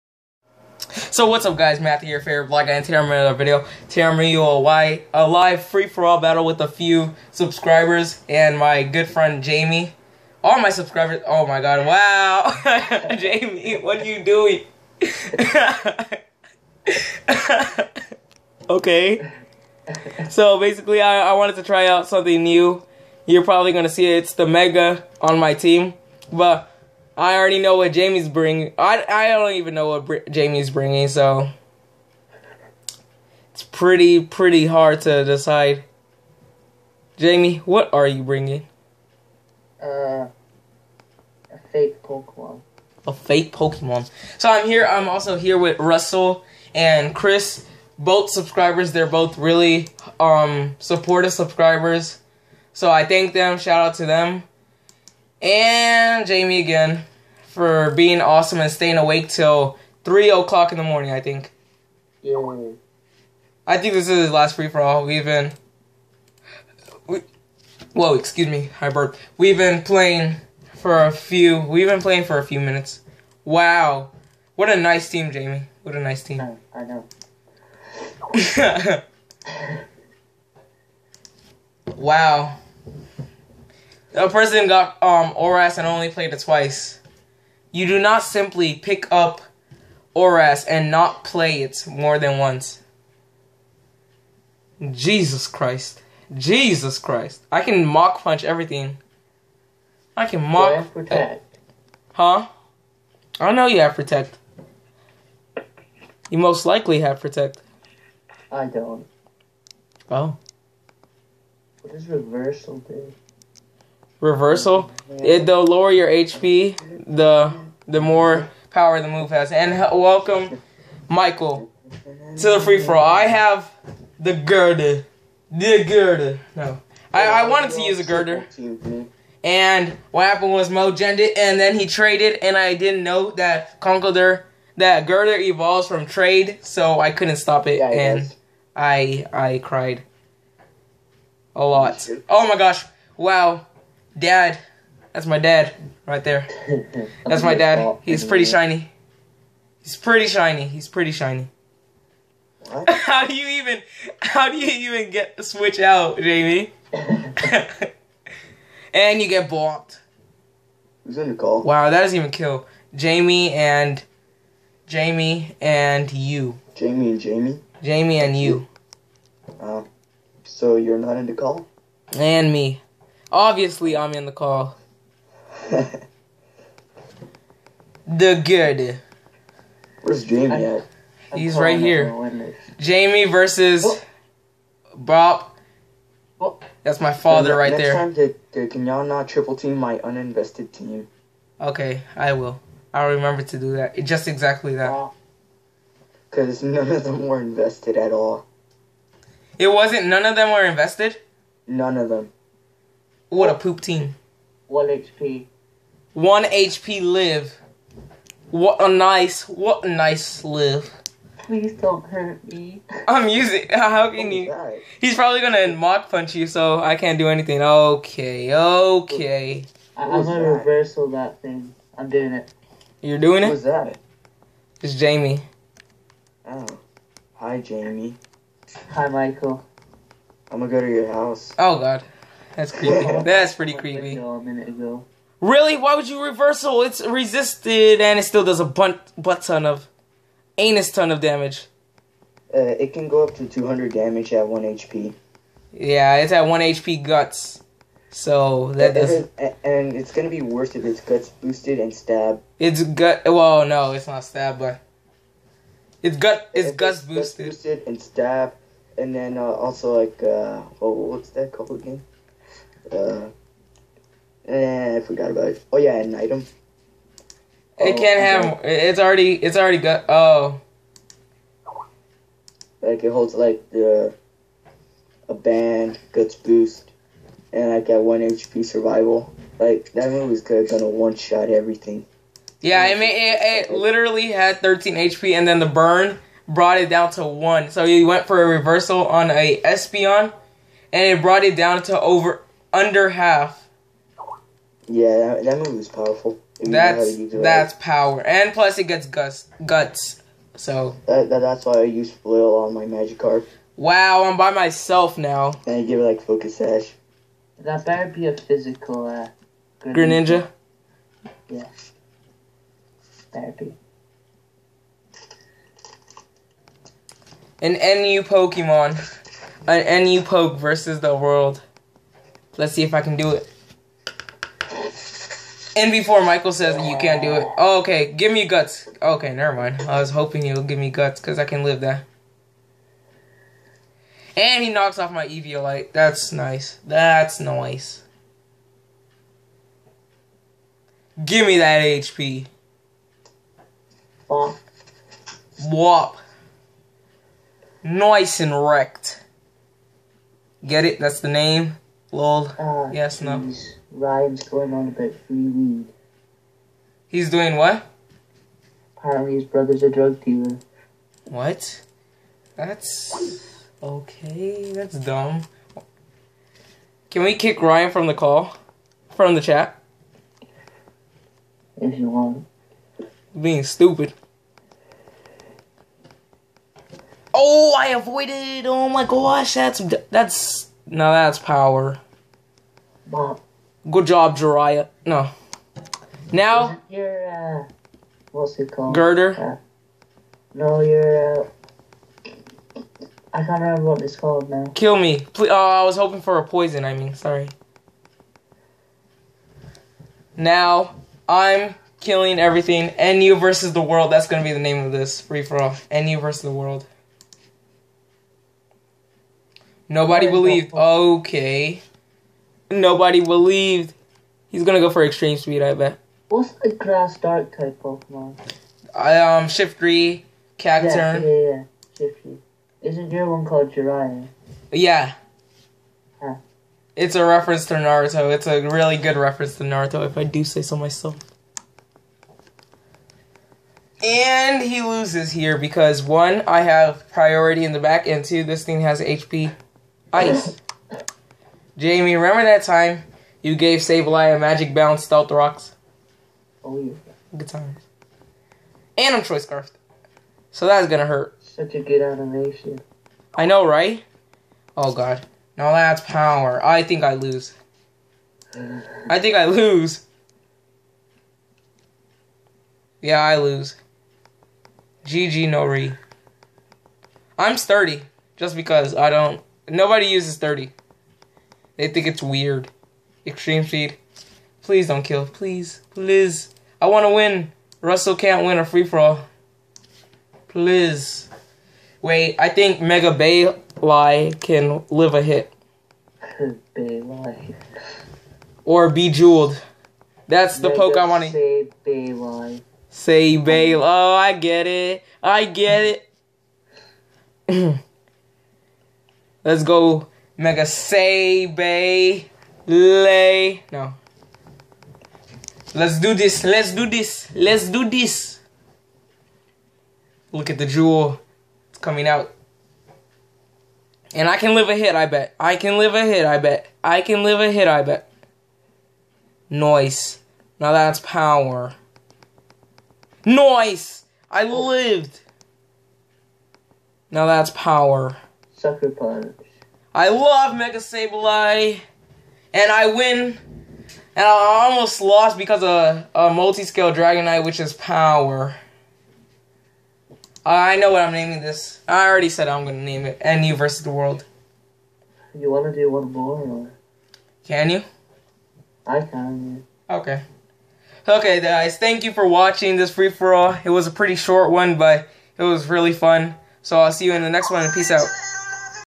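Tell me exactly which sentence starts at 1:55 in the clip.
It, the lower your HP, the the more power the move has.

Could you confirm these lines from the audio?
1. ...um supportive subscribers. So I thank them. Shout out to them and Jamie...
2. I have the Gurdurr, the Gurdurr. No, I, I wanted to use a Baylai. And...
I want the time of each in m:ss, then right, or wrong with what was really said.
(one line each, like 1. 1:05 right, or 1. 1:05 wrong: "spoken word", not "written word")
1. 0:50 right
2. 2:03 wrong: "Gurdurr", not "Baylai".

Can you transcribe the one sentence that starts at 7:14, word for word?
And he loses here because, one, I have priority in the back, and two, this thing has HP.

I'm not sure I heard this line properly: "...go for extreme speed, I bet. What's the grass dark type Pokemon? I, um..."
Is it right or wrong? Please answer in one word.
right.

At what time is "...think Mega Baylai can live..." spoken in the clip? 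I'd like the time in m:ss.
8:02.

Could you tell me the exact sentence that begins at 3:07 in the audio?
time, can y'all not triple team my uninvested team?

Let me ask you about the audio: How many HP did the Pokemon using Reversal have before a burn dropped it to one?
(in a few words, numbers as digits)
13.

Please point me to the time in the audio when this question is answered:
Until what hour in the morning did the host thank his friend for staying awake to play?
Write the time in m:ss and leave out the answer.
1:00.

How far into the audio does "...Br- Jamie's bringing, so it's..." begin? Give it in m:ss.
0:30.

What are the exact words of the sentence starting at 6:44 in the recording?
That's going to be the name of this free for all.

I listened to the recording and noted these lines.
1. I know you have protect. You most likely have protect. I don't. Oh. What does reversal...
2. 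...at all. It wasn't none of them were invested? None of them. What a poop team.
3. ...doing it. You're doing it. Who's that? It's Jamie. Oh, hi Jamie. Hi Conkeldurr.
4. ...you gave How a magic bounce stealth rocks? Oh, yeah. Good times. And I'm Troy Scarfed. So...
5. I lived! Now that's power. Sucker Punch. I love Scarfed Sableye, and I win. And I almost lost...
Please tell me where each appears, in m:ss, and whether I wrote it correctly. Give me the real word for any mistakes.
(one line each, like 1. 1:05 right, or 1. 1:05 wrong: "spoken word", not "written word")
1. 1:43 right
2. 3:17 right
3. 3:42 wrong: "Michael", not "Conkeldurr"
4. 7:23 wrong: "Sableye", not "How"
5. 8:44 wrong: "Mega", not "Scarfed".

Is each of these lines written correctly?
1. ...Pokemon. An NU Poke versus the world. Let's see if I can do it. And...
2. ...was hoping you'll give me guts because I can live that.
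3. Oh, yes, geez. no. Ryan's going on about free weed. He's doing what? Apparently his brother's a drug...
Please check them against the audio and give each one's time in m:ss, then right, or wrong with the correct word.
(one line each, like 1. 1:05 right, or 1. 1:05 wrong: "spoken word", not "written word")
1. 5:18 right
2. 5:30 right
3. 5:52 right.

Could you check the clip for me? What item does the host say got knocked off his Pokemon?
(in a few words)
Eviolite.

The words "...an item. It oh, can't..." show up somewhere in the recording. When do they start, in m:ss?
4:25.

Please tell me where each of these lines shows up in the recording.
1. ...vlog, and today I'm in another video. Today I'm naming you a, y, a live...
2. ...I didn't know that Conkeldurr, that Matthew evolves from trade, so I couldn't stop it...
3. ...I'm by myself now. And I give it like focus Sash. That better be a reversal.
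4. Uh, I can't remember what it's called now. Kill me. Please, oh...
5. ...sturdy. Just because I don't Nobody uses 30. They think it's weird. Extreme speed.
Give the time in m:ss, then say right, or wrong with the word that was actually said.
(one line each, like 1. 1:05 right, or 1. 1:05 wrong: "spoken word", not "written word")
1. 0:02 wrong: "bringing", not "naming"
2. 2:12 wrong: "Gurdurr", not "Matthew"
3. 5:04 wrong: "physical", not "reversal"
4. 6:31 right
5. 7:47 right.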